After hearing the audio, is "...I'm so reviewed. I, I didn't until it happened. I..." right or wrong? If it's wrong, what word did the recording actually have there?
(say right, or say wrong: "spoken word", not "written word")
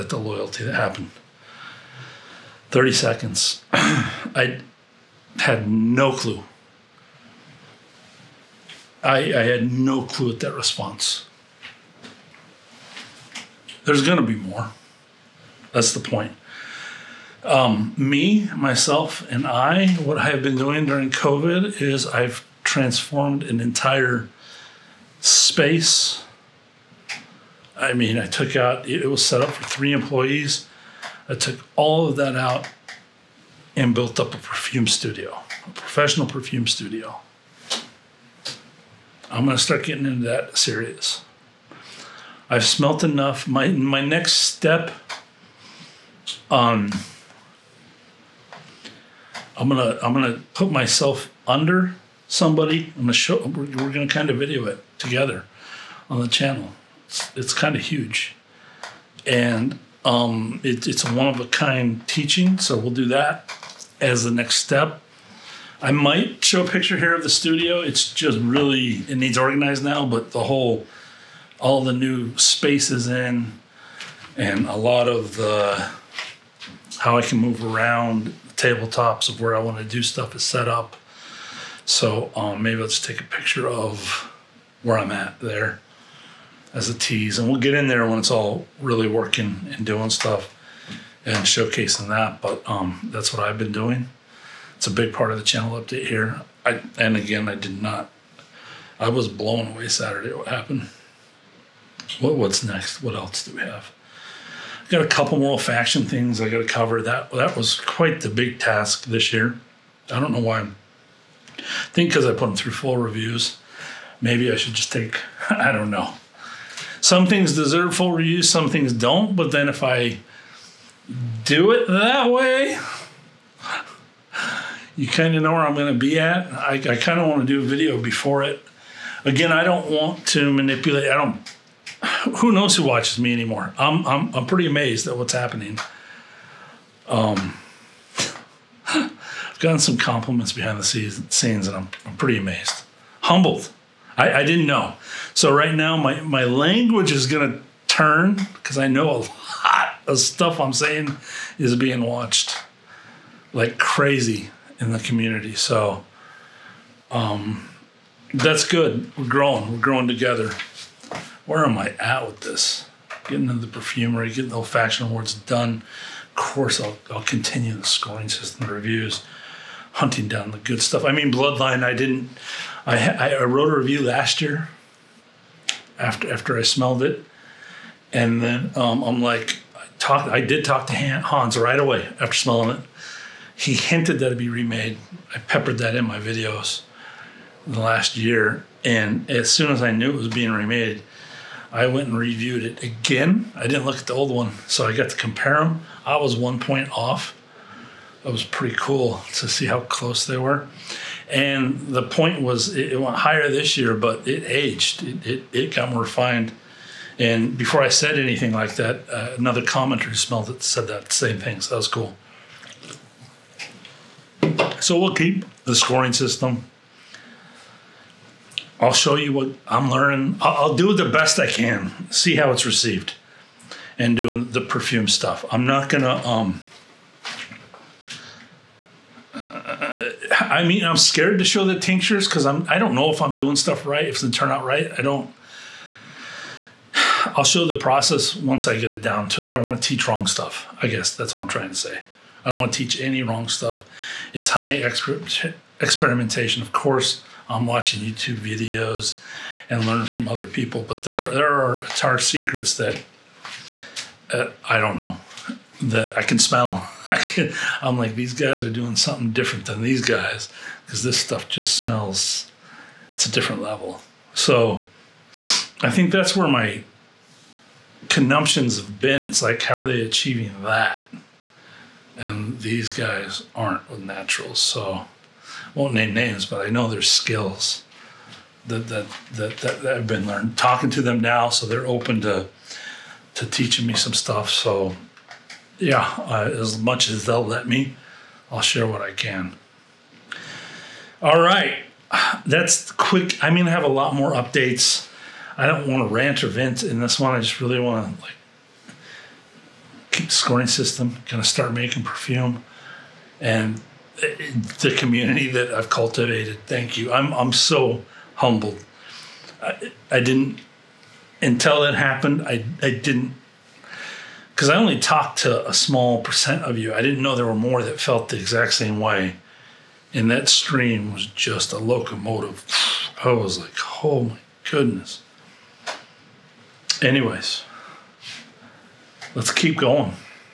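wrong: "humbled", not "reviewed".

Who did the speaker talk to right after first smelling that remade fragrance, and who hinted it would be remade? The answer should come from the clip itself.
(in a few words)
Hans.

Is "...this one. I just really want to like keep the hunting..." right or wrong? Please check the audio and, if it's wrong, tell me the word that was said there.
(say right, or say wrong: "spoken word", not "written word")
wrong: "scoring", not "hunting".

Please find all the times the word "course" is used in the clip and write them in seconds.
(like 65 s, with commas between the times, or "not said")
166 s, 246 s.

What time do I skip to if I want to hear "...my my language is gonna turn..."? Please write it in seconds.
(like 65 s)
145 s.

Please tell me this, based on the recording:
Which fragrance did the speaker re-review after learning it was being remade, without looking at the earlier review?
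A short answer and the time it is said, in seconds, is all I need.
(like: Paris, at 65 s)
Bloodline, at 171 s.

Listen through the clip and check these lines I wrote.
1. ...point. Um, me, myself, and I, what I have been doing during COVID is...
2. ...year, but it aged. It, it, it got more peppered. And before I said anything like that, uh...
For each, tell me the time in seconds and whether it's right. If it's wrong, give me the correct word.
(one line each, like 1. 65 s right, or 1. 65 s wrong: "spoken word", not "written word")
1. 16 s right
2. 203 s wrong: "refined", not "peppered".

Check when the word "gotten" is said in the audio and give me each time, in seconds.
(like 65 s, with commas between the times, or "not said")
139 s.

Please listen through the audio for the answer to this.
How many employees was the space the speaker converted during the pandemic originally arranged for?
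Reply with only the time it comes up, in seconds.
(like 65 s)
29 s.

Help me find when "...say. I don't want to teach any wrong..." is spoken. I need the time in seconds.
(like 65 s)
241 s.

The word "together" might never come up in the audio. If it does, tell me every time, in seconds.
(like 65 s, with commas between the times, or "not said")
54 s, 160 s.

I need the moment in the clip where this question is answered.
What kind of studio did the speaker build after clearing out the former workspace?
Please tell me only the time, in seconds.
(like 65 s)
35 s.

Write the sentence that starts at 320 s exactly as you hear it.
And that stream was just a locomotive.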